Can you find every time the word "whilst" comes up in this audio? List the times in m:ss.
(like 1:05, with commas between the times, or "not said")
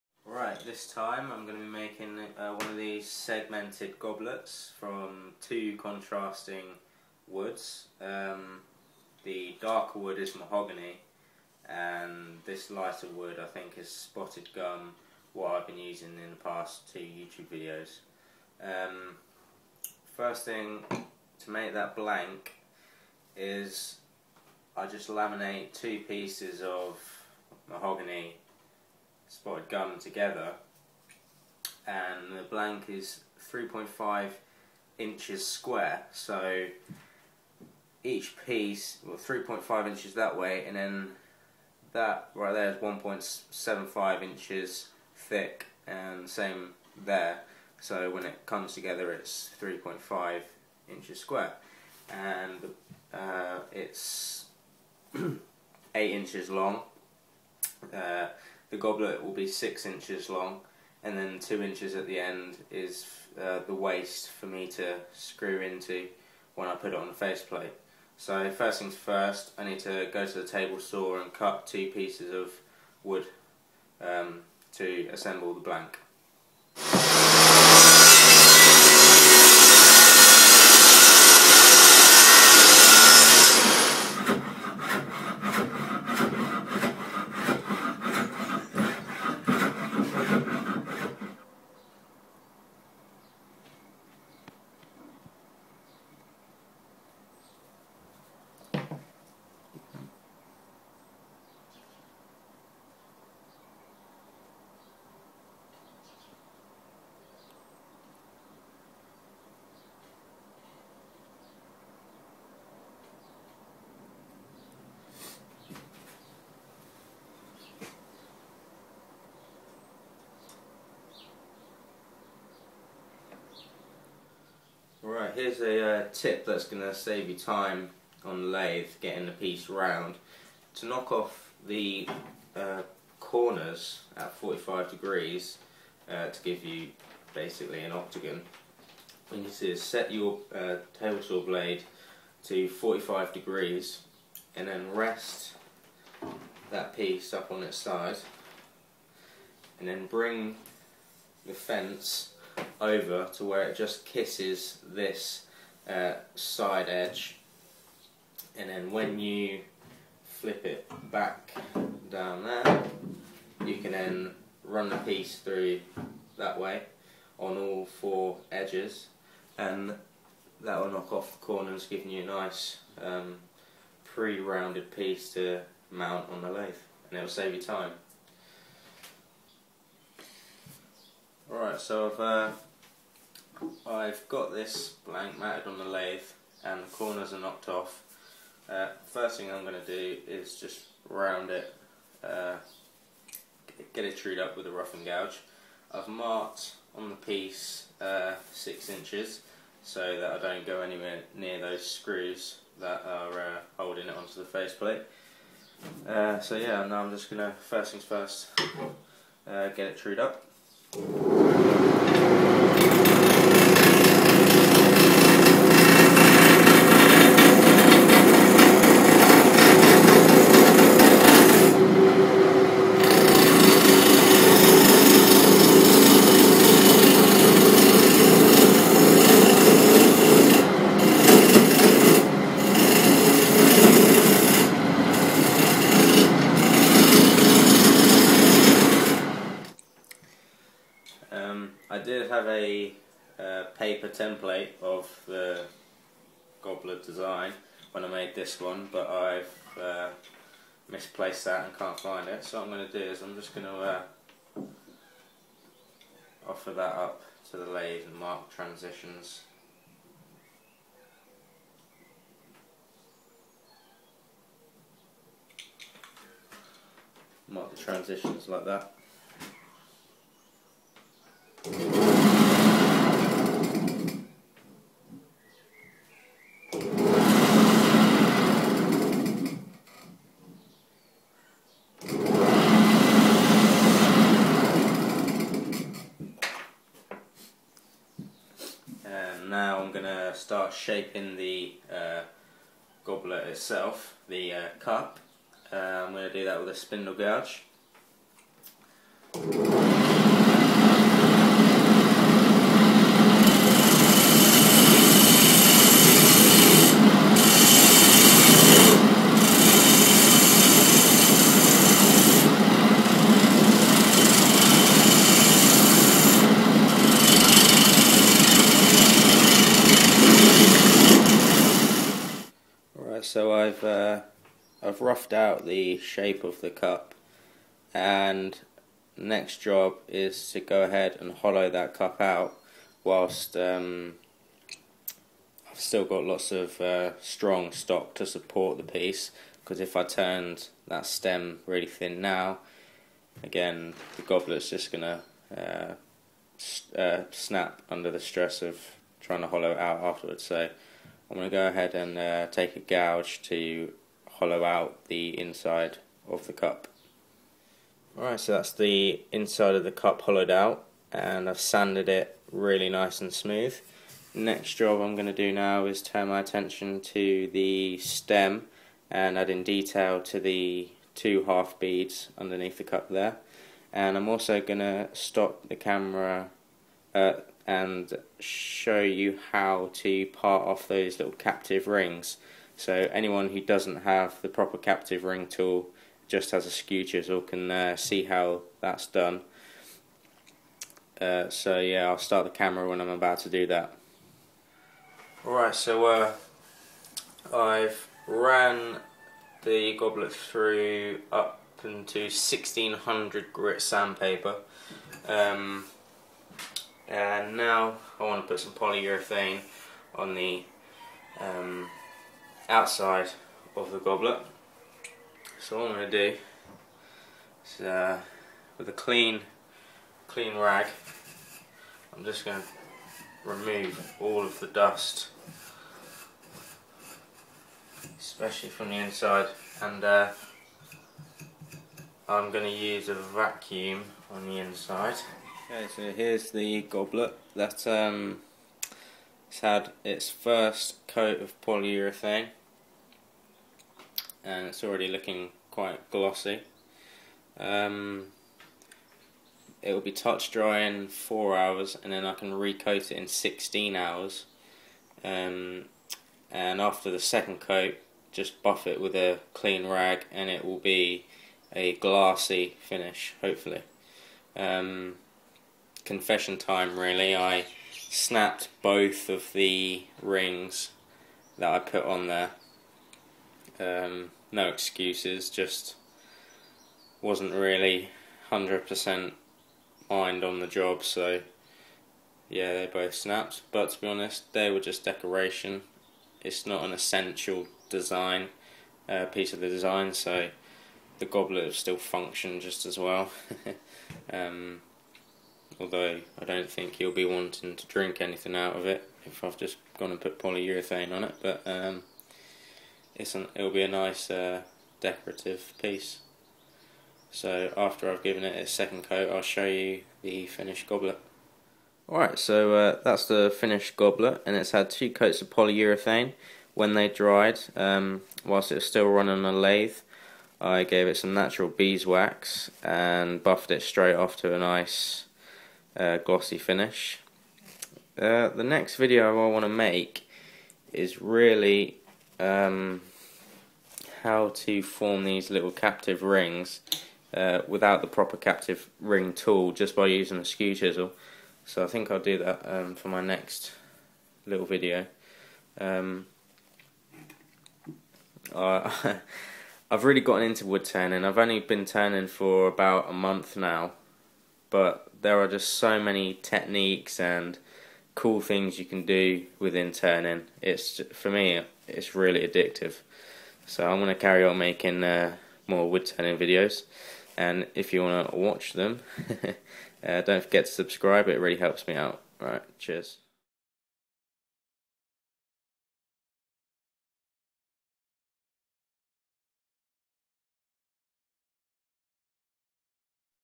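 5:33, 8:38.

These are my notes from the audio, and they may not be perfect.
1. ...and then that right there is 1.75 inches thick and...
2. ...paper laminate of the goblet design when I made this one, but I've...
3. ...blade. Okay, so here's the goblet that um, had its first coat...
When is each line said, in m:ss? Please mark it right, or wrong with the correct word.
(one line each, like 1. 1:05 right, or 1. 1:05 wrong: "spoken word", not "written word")
1. 0:40 right
2. 4:03 wrong: "template", not "laminate"
3. 7:14 wrong: "inside", not "blade".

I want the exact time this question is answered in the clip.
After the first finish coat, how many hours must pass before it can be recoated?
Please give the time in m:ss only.
7:33.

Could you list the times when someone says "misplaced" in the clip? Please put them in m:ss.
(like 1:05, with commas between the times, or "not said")
4:10.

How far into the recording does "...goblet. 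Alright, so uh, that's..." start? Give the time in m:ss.
8:30.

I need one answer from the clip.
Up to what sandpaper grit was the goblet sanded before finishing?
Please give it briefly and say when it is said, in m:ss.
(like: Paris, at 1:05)
1600, at 6:42.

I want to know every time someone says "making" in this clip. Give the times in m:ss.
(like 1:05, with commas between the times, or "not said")
0:01, 9:24.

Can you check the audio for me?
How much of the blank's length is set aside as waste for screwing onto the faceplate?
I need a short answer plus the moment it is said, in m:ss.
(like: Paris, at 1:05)
2 inches, at 1:01.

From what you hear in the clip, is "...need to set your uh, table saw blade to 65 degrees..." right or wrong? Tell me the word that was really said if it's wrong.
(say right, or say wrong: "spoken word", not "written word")
wrong: "45", not "65".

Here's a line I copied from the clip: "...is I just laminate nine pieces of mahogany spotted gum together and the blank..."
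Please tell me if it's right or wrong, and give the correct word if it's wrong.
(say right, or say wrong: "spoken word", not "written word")
wrong: "two", not "nine".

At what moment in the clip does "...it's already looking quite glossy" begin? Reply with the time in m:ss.
7:24.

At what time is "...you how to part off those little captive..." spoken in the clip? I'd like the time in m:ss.
6:19.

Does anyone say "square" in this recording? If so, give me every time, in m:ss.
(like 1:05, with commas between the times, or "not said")
0:35, 0:51.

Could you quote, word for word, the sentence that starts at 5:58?
Alright, so that's the inside of the cup hollowed out and I've sanded it really nice and smooth.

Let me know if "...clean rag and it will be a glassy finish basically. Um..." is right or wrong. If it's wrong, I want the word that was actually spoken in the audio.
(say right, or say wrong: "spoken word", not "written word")
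wrong: "hopefully", not "basically".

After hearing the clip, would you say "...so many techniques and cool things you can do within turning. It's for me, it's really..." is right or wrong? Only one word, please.
right.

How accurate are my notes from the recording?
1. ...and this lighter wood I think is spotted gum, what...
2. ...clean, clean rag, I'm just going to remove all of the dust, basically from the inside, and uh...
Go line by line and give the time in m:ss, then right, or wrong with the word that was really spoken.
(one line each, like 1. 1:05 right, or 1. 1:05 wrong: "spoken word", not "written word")
1. 0:11 right
2. 6:58 wrong: "especially", not "basically".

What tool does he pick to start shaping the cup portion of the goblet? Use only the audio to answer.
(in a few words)
spindle gouge.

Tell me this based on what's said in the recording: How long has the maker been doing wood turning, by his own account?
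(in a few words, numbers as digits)
about a month.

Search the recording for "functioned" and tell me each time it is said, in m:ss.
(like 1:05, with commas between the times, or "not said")
8:11.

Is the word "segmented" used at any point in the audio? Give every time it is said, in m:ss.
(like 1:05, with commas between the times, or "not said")
0:03.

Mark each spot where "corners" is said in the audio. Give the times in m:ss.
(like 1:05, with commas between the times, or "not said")
2:13, 2:51, 3:06.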